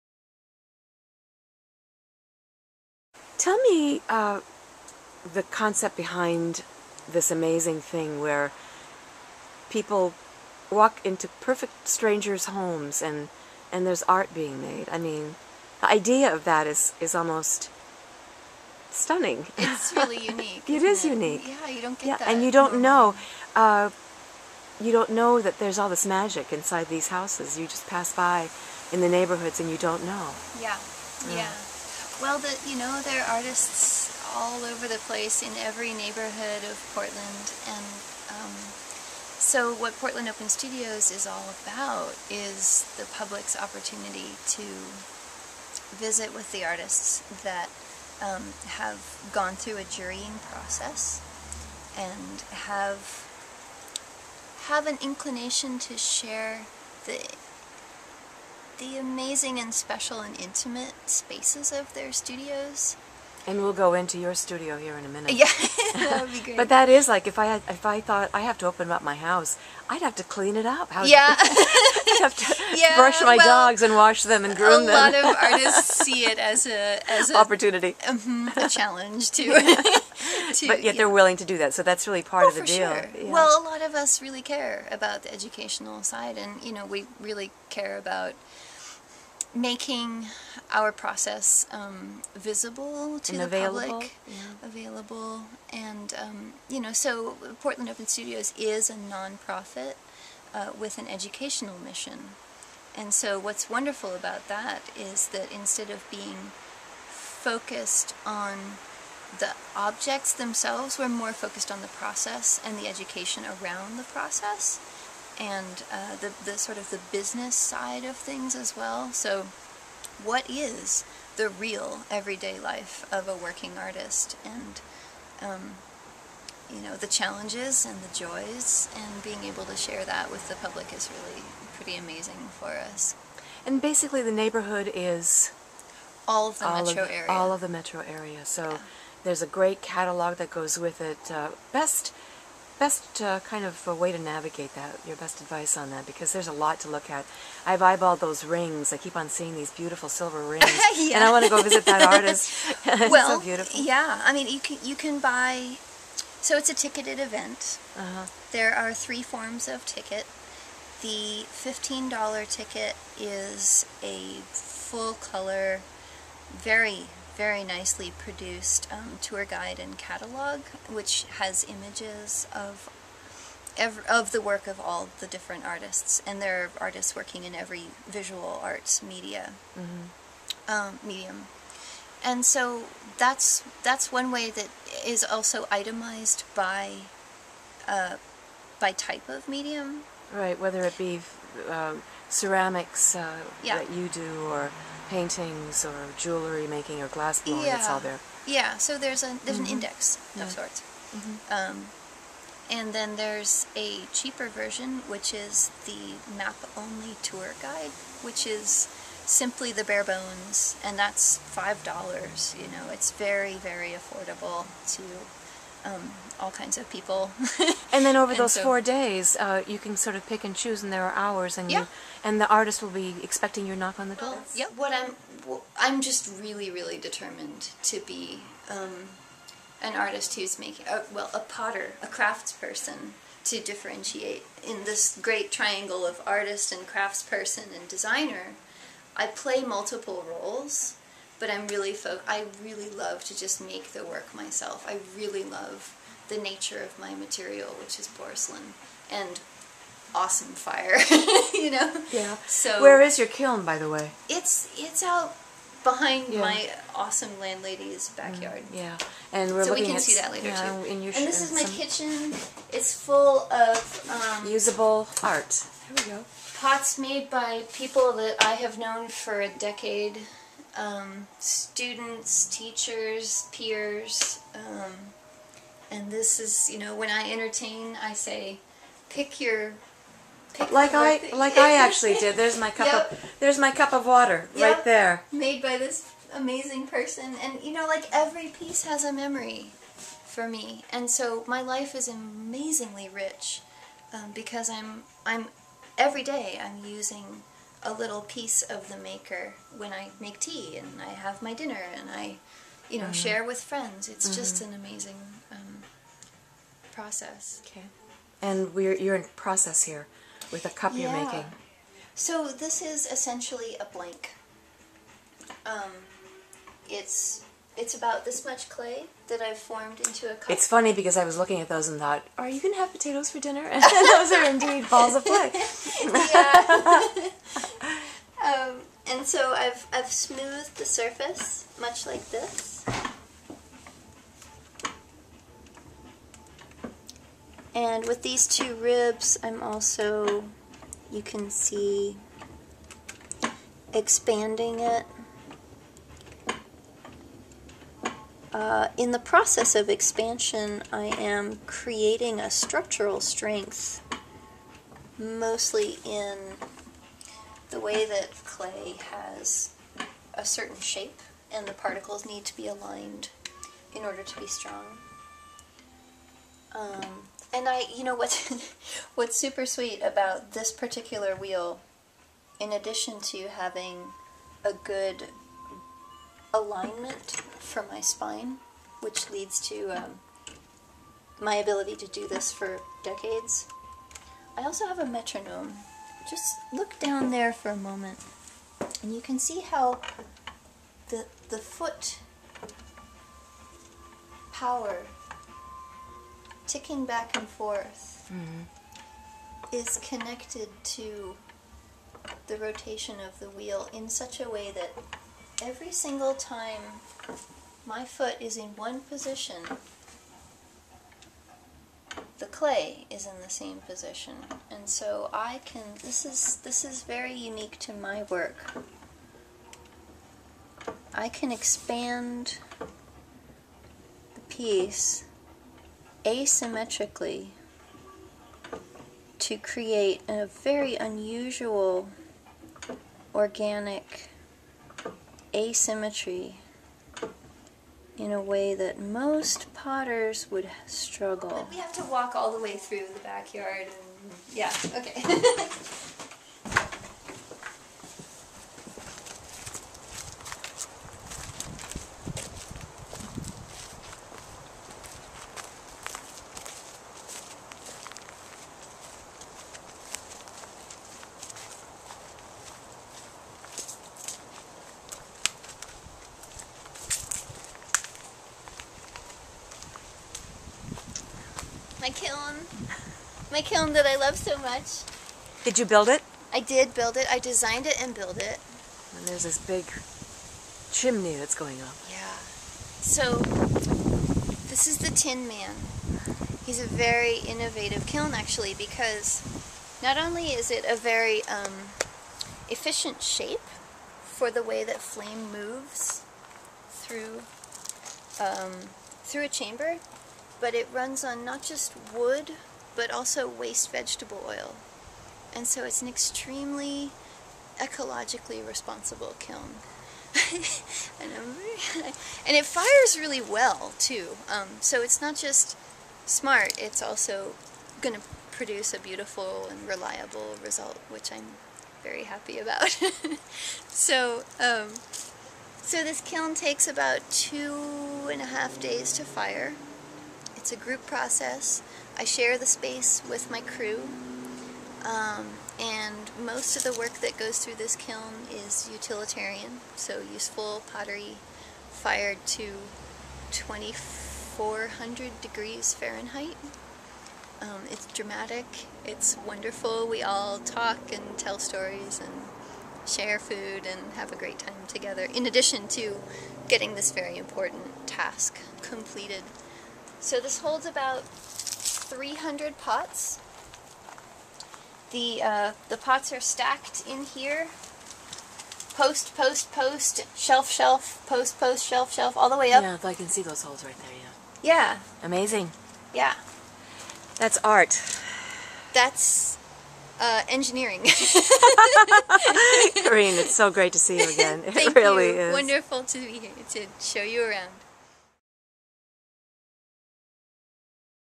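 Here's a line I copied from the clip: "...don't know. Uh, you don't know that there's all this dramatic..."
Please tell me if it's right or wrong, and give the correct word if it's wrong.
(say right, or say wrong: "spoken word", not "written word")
wrong: "magic", not "dramatic".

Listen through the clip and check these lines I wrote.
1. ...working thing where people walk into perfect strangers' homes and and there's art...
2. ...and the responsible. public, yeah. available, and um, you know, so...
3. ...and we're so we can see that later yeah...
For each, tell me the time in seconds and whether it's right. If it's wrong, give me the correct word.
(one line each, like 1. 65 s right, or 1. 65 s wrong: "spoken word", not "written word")
1. 7 s wrong: "amazing", not "working"
2. 93 s wrong: "available", not "responsible"
3. 259 s right.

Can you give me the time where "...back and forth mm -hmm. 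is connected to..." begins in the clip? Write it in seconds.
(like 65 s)
397 s.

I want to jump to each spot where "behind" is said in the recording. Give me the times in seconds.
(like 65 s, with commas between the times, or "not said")
5 s, 255 s.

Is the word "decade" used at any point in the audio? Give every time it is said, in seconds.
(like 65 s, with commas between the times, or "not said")
269 s, 383 s.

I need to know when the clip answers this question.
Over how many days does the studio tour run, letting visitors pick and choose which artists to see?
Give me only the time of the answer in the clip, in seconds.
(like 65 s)
218 s.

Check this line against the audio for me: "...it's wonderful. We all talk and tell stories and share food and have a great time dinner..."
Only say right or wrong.
wrong.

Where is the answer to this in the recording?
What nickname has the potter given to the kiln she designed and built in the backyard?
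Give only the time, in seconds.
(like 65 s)
484 s.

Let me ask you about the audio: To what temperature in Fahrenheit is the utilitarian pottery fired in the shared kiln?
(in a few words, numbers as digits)
2400 degrees.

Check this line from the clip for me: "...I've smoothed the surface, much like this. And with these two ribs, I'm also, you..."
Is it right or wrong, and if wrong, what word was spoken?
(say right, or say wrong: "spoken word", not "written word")
right.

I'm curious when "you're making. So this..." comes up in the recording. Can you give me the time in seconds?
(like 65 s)
311 s.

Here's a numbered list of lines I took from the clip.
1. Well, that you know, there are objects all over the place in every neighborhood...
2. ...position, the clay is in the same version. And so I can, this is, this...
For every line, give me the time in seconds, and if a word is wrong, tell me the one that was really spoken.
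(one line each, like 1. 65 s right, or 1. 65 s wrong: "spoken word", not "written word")
1. 32 s wrong: "artists", not "objects"
2. 409 s wrong: "position", not "version".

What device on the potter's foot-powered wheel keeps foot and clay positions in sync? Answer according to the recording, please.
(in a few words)
metronome.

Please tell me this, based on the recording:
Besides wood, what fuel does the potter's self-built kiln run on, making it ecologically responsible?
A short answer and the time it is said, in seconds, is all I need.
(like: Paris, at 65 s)
waste vegetable oil, at 503 s.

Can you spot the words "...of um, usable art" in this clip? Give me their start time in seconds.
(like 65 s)
263 s.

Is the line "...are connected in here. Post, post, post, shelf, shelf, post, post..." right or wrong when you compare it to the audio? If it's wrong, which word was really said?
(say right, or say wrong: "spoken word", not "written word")
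wrong: "stacked", not "connected".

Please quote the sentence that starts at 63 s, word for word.
And we'll go into your studio here in a minute.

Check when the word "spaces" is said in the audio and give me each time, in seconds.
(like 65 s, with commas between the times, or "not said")
61 s, 532 s.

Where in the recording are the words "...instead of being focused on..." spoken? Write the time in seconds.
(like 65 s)
105 s.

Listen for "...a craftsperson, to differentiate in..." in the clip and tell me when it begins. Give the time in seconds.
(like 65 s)
232 s.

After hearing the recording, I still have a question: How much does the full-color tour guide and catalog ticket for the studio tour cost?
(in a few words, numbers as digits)
$15.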